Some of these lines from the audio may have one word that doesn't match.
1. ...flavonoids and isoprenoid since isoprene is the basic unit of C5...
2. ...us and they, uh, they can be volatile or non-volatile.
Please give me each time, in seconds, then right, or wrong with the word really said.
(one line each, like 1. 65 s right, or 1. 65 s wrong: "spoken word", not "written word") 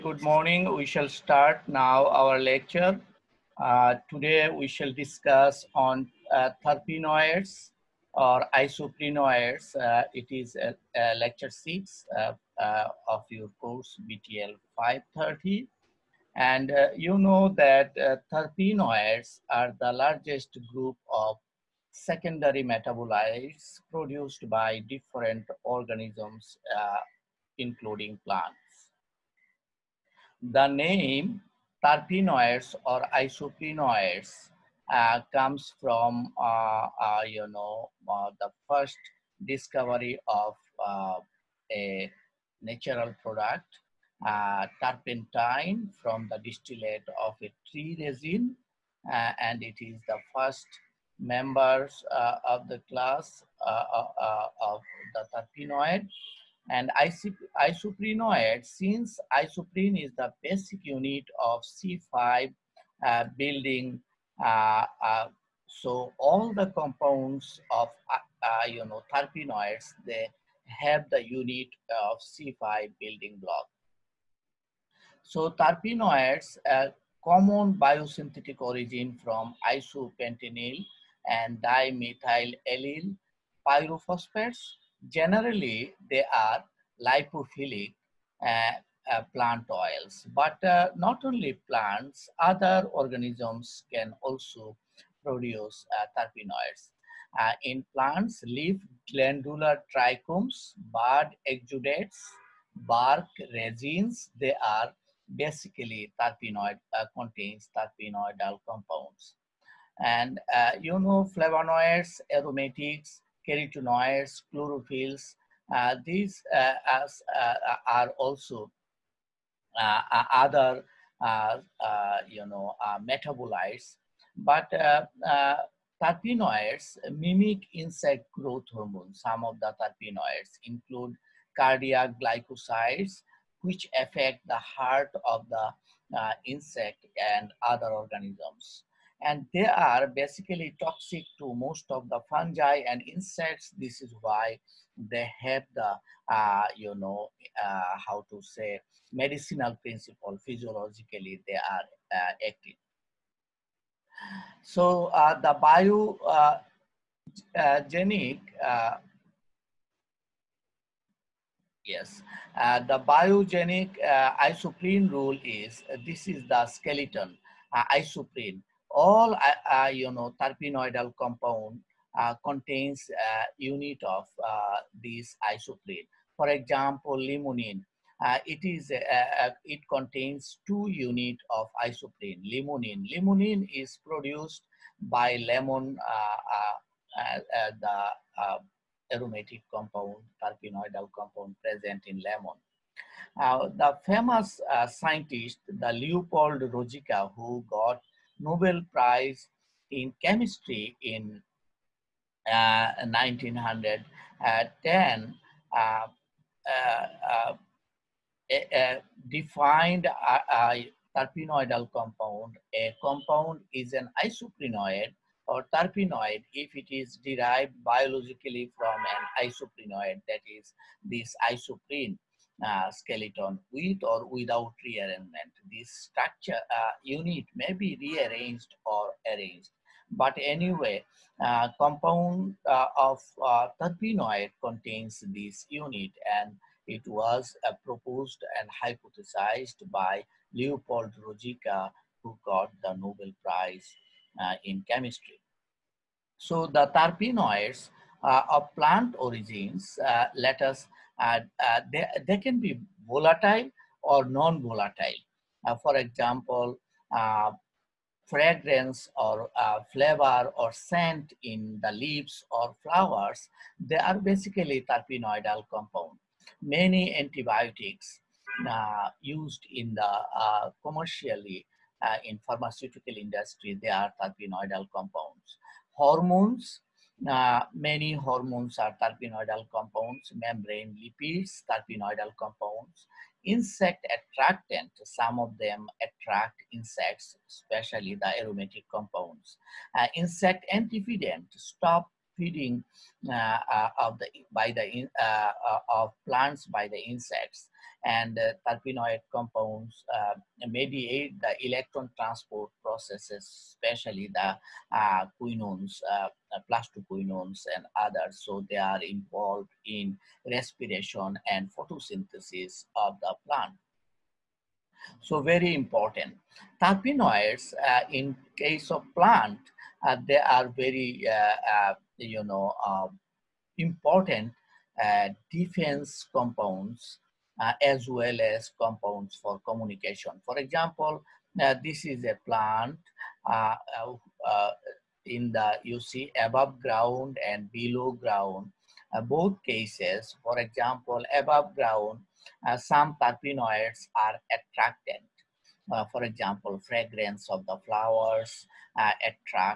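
1. 55 s wrong: "terpenoids", not "flavonoids"
2. 250 s right.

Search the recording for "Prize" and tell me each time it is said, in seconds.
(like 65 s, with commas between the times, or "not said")
198 s, 243 s.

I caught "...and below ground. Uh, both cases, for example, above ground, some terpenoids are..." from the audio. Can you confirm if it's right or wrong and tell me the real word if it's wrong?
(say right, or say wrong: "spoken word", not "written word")
right.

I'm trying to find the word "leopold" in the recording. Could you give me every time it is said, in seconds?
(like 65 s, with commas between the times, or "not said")
195 s, 240 s.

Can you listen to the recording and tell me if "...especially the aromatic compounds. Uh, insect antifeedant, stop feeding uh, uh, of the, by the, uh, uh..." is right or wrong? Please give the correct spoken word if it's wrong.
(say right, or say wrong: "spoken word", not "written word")
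right.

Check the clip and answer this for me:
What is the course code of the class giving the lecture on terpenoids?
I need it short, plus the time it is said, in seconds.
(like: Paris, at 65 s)
BTL 530, at 14 s.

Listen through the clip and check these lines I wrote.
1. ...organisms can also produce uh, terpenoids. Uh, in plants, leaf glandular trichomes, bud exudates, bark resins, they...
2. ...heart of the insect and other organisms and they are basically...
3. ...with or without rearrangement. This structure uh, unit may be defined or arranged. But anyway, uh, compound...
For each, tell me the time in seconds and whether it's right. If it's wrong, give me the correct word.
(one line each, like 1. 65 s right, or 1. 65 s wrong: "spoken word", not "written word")
1. 92 s right
2. 134 s right
3. 223 s wrong: "rearranged", not "defined".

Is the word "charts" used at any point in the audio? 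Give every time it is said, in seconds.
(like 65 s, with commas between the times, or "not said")
not said.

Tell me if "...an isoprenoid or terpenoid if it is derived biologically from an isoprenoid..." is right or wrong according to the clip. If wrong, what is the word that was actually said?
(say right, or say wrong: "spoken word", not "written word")
right.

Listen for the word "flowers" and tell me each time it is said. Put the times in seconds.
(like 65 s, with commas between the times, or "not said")
262 s, 347 s.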